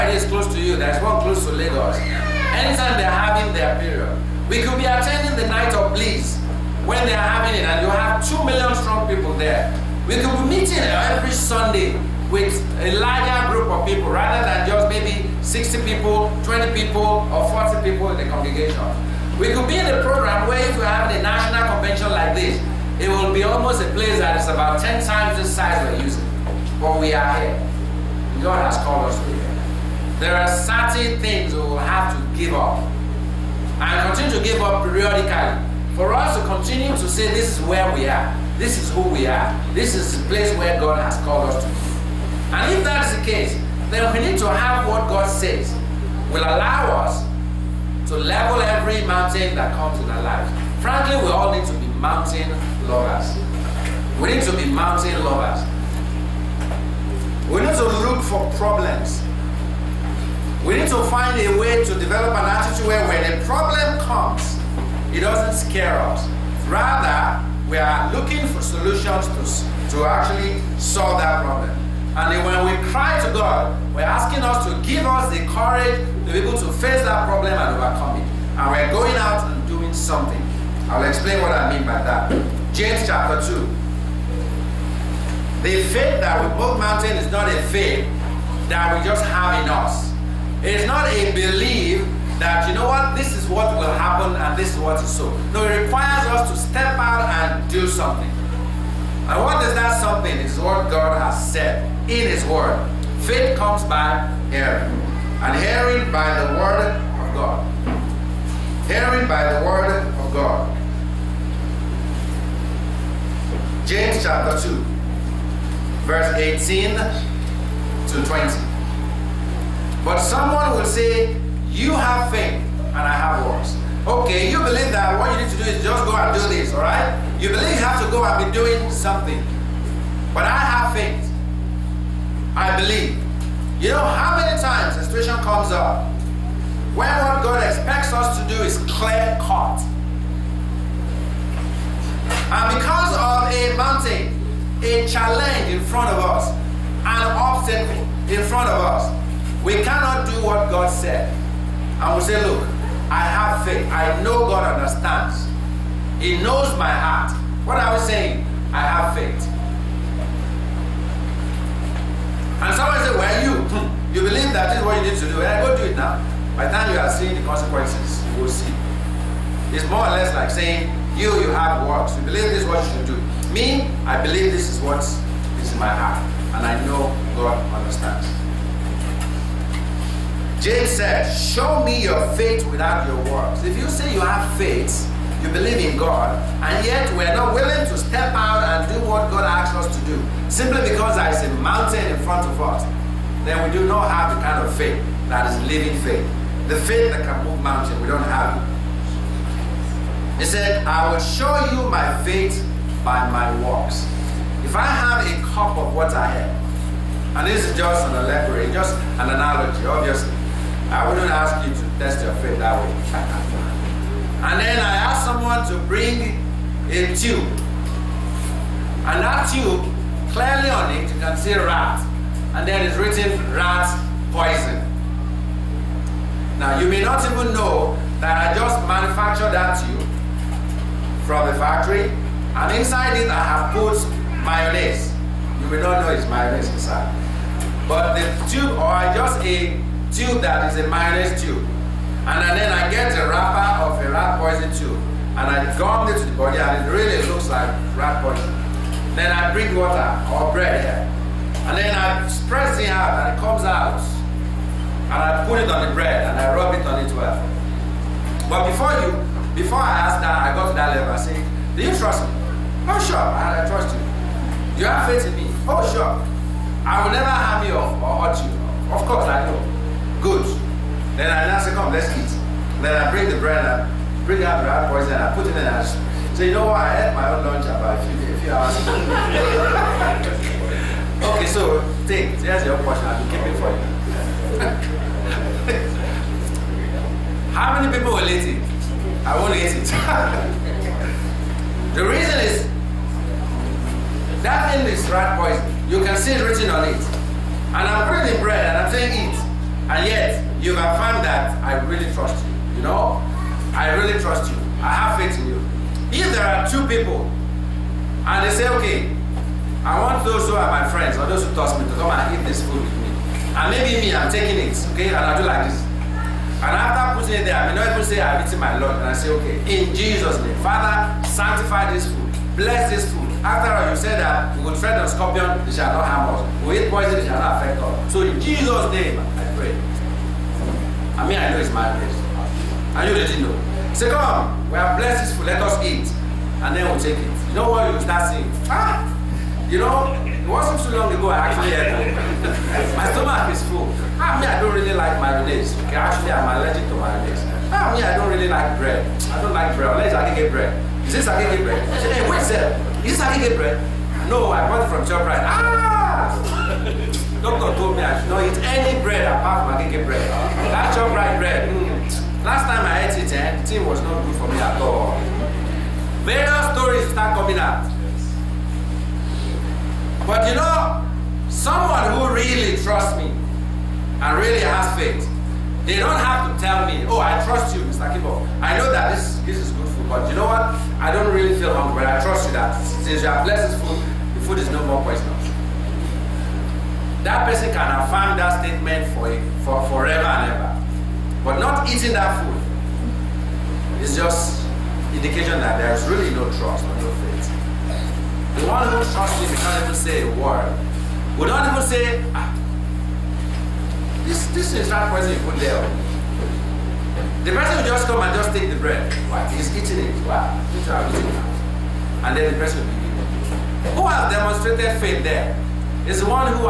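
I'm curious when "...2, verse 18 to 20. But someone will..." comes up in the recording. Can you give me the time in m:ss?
1:54.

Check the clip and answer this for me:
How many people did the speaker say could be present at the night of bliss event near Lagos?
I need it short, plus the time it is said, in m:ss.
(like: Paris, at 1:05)
2 million, at 0:08.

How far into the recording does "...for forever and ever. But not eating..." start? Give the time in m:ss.
6:29.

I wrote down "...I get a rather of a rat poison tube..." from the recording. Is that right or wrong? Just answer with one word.
wrong.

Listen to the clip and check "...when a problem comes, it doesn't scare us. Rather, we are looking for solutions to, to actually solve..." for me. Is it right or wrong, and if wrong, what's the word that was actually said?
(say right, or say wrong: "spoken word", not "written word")
right.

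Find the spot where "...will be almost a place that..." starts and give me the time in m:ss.
0:23.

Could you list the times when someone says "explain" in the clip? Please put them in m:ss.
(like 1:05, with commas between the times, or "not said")
1:21.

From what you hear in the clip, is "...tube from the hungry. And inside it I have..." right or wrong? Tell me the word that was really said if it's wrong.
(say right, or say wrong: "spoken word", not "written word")
wrong: "factory", not "hungry".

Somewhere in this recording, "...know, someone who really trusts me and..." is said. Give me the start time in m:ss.
6:10.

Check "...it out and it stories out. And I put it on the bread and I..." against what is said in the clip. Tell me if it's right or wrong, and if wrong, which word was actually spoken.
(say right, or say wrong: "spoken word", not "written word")
wrong: "comes", not "stories".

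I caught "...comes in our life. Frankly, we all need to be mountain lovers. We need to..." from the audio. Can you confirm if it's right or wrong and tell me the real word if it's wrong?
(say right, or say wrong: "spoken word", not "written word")
right.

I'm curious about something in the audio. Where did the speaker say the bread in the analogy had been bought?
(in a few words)
Shoprite.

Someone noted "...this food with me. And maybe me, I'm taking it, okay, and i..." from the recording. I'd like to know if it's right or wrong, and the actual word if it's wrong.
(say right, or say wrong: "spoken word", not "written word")
right.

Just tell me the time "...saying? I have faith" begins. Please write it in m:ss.
2:38.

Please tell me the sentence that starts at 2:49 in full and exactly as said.
It's more or less like saying, you, you have works.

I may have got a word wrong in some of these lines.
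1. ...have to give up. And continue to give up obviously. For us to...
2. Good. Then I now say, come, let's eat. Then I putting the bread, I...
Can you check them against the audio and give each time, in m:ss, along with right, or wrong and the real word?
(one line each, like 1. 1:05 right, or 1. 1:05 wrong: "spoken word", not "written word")
1. 0:31 wrong: "periodically", not "obviously"
2. 4:30 wrong: "bring", not "putting".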